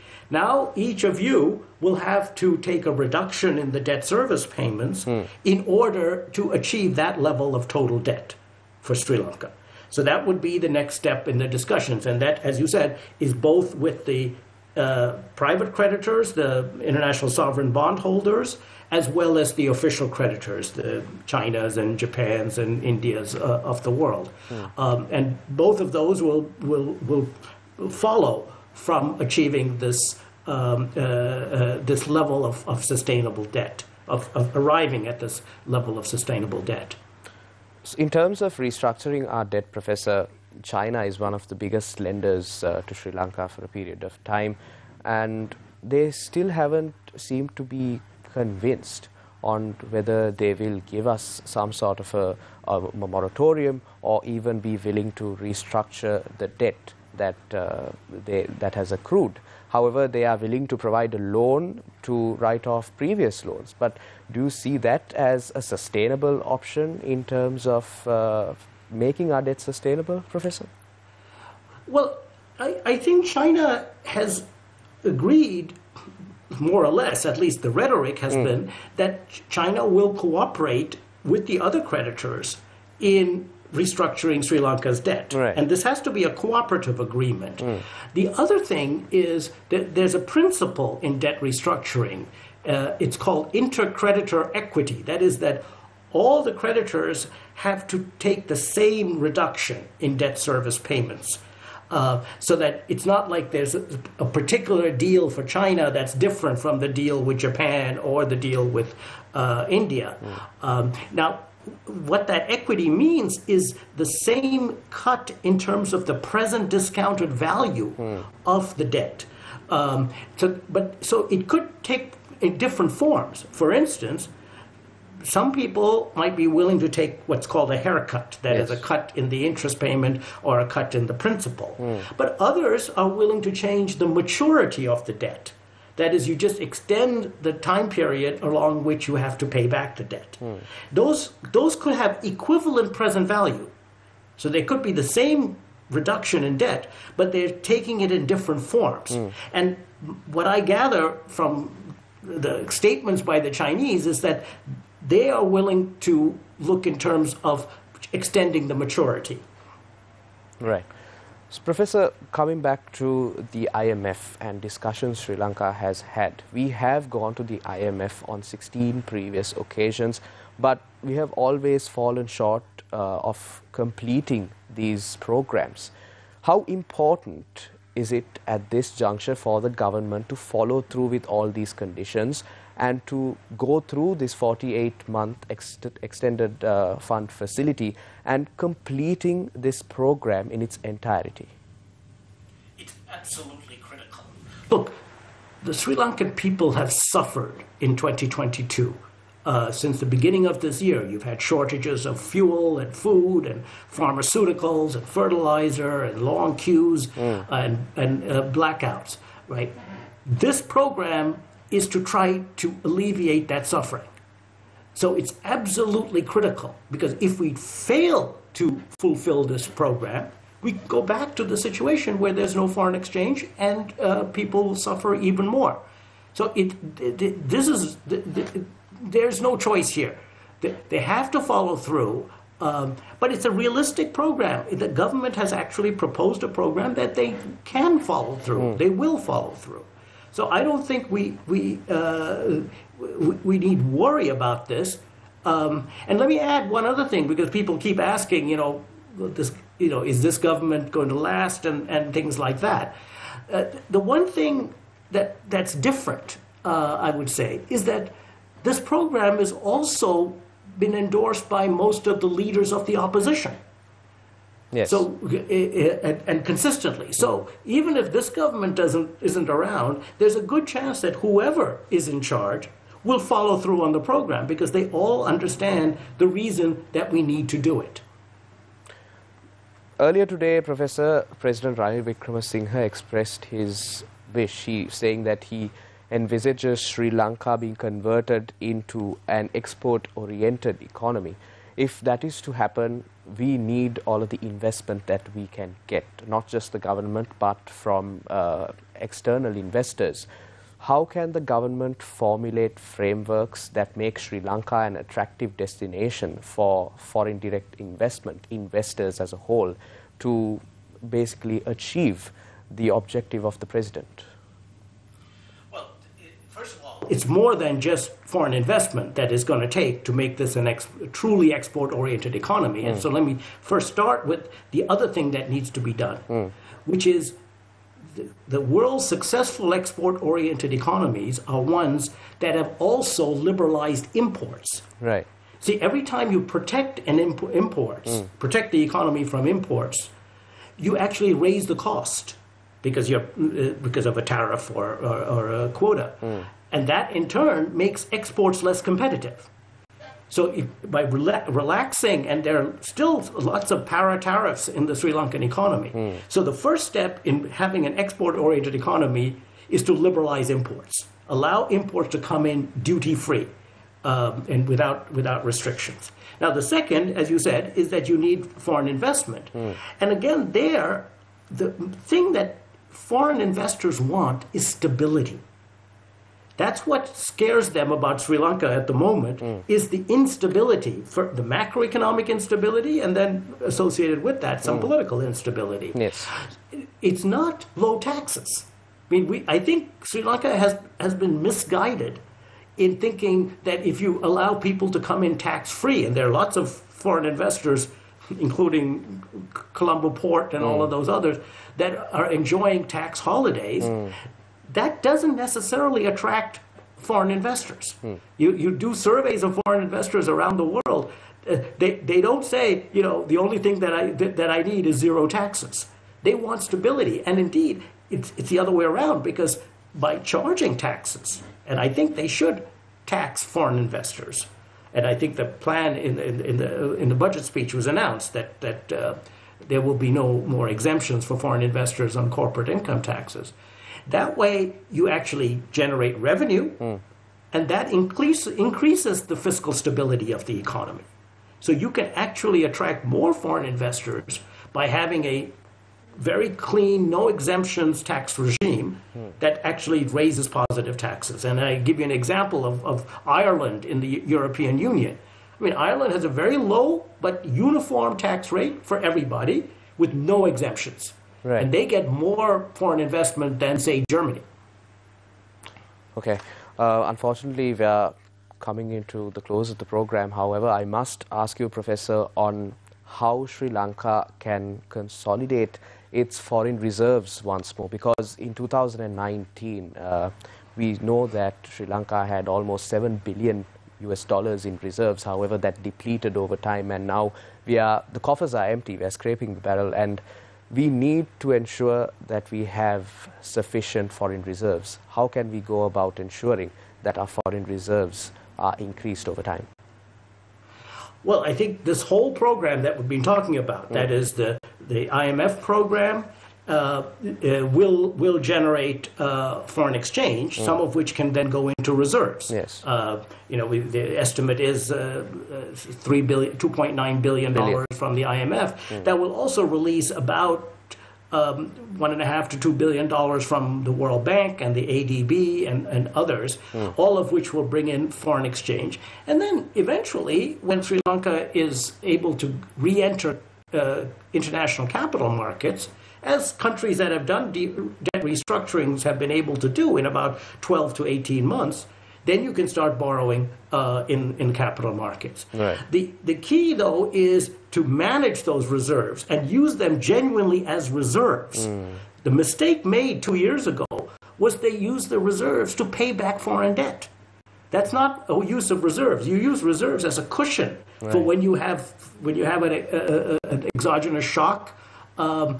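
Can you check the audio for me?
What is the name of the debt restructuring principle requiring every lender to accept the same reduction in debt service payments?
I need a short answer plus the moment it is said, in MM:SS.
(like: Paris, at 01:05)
Intercreditor equity, at 01:33.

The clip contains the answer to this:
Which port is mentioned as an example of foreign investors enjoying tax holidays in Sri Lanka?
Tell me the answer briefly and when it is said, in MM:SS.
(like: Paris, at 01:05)
Colombo Port, at 06:39.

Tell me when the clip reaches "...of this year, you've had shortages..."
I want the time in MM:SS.
03:20.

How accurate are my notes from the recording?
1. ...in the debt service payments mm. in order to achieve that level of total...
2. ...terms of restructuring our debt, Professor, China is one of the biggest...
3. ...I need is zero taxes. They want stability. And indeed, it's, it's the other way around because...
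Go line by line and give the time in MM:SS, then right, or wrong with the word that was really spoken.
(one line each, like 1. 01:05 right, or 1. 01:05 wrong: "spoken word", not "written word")
1. 00:03 right
2. 00:38 right
3. 06:54 right.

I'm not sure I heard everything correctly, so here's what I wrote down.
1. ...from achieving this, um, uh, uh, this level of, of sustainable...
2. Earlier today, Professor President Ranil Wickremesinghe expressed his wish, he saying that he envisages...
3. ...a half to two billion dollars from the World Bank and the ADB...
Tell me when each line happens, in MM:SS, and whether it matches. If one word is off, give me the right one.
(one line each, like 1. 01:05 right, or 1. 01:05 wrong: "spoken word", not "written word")
1. 00:28 right
2. 04:39 right
3. 08:42 right.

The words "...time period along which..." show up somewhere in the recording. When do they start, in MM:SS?
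02:17.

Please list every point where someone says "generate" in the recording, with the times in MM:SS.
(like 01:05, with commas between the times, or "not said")
07:15, 08:28.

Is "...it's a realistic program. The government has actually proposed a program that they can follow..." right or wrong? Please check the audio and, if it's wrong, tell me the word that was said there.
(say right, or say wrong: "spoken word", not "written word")
right.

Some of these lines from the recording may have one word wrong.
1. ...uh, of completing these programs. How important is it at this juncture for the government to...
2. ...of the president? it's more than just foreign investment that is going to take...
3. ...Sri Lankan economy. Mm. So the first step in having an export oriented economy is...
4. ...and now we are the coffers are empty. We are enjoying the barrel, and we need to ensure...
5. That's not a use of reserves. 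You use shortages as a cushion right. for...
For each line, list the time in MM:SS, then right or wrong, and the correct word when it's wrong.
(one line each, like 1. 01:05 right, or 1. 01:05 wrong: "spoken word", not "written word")
1. 02:52 right
2. 05:13 right
3. 05:54 right
4. 08:06 wrong: "scraping", not "enjoying"
5. 09:17 wrong: "reserves", not "shortages".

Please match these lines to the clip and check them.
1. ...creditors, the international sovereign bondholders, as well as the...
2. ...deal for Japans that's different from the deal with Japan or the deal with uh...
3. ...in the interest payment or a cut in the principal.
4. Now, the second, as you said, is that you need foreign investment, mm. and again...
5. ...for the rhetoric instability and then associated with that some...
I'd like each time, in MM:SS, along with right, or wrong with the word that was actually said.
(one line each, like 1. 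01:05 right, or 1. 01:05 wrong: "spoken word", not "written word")
1. 00:15 right
2. 01:44 wrong: "China", not "Japans"
3. 02:09 right
4. 06:06 right
5. 06:21 wrong: "macroeconomic", not "rhetoric".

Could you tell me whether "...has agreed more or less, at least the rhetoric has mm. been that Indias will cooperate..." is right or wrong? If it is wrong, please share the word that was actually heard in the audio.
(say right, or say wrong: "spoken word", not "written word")
wrong: "China", not "Indias".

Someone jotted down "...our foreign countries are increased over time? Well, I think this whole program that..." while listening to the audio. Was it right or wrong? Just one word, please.
wrong.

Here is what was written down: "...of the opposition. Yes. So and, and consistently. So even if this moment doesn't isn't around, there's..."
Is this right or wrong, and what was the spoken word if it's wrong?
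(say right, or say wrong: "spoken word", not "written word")
wrong: "government", not "moment".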